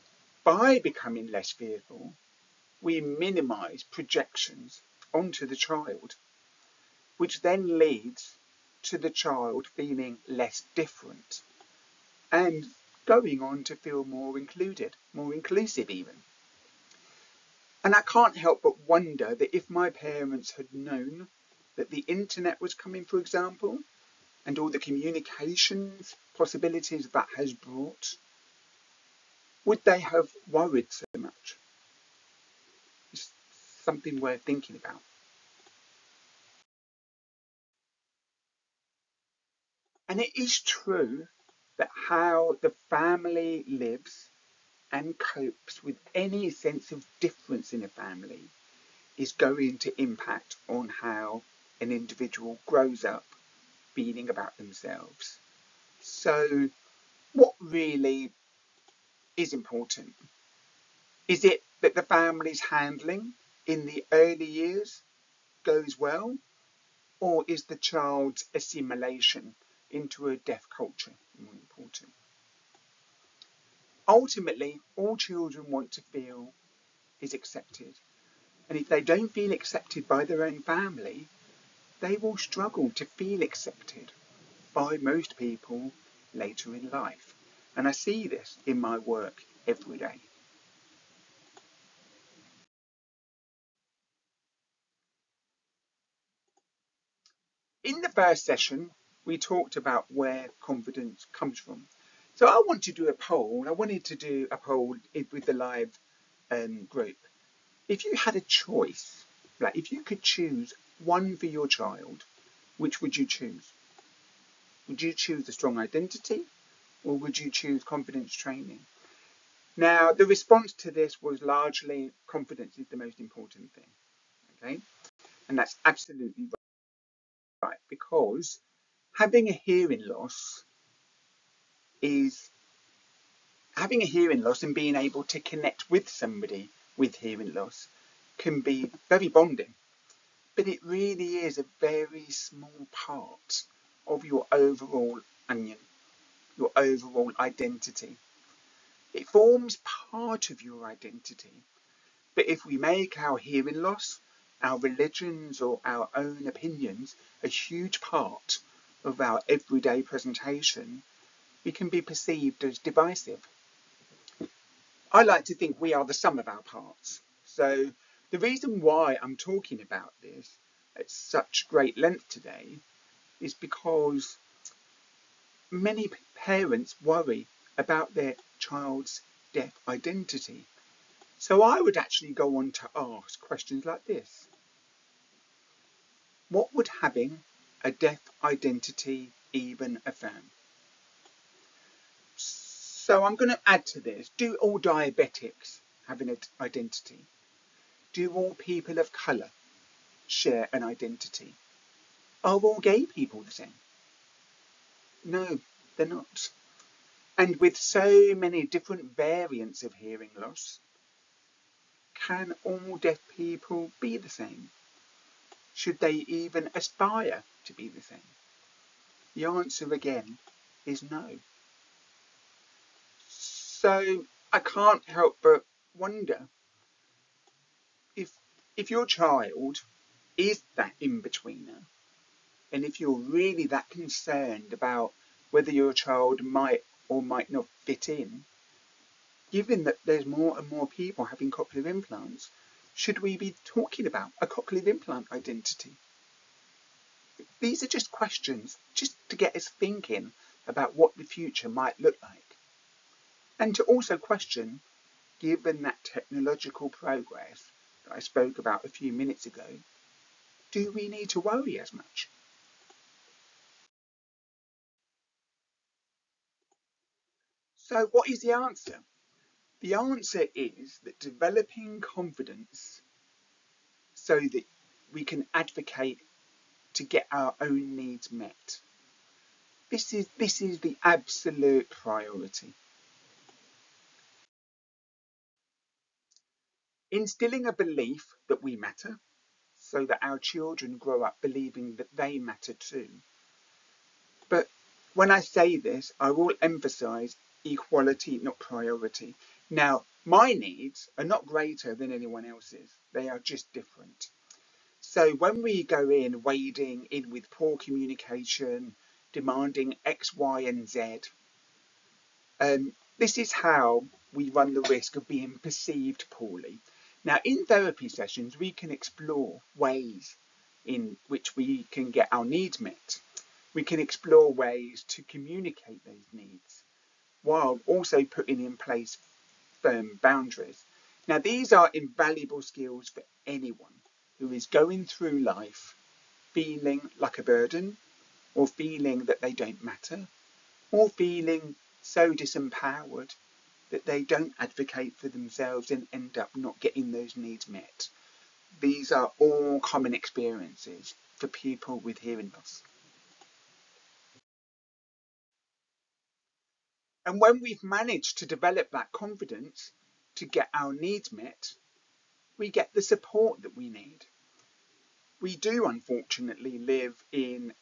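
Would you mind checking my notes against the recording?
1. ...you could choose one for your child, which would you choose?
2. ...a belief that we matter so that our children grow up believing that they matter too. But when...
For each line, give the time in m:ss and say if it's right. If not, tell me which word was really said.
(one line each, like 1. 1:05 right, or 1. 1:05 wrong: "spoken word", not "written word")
1. 1:49 right
2. 4:47 right.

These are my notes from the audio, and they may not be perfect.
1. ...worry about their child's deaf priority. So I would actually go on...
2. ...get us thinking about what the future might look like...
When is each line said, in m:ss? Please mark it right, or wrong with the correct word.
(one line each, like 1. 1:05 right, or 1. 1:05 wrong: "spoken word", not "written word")
1. 2:57 wrong: "identity", not "priority"
2. 4:09 right.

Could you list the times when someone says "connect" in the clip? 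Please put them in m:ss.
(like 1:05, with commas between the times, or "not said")
2:15.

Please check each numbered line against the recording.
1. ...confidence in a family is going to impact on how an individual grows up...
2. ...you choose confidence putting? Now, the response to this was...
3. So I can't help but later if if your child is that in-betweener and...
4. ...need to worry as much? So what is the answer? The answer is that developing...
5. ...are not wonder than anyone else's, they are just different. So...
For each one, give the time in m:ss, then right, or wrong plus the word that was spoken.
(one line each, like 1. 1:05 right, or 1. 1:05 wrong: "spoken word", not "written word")
1. 0:47 wrong: "difference", not "confidence"
2. 1:57 wrong: "training", not "putting"
3. 3:43 wrong: "wonder", not "later"
4. 4:21 right
5. 5:01 wrong: "greater", not "wonder".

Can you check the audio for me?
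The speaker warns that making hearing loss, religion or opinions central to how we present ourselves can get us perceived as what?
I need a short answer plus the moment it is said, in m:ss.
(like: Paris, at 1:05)
divisive, at 2:42.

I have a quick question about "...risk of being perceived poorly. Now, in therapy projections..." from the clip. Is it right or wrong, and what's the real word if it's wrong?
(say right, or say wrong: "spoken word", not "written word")
wrong: "sessions", not "projections".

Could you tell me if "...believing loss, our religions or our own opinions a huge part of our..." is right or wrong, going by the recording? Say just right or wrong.
wrong.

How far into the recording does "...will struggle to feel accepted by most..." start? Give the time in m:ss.
1:22.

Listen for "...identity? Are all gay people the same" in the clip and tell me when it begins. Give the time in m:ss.
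3:20.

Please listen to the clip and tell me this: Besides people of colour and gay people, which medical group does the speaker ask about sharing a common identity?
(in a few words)
diabetics.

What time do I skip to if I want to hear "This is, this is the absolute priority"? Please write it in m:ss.
4:39.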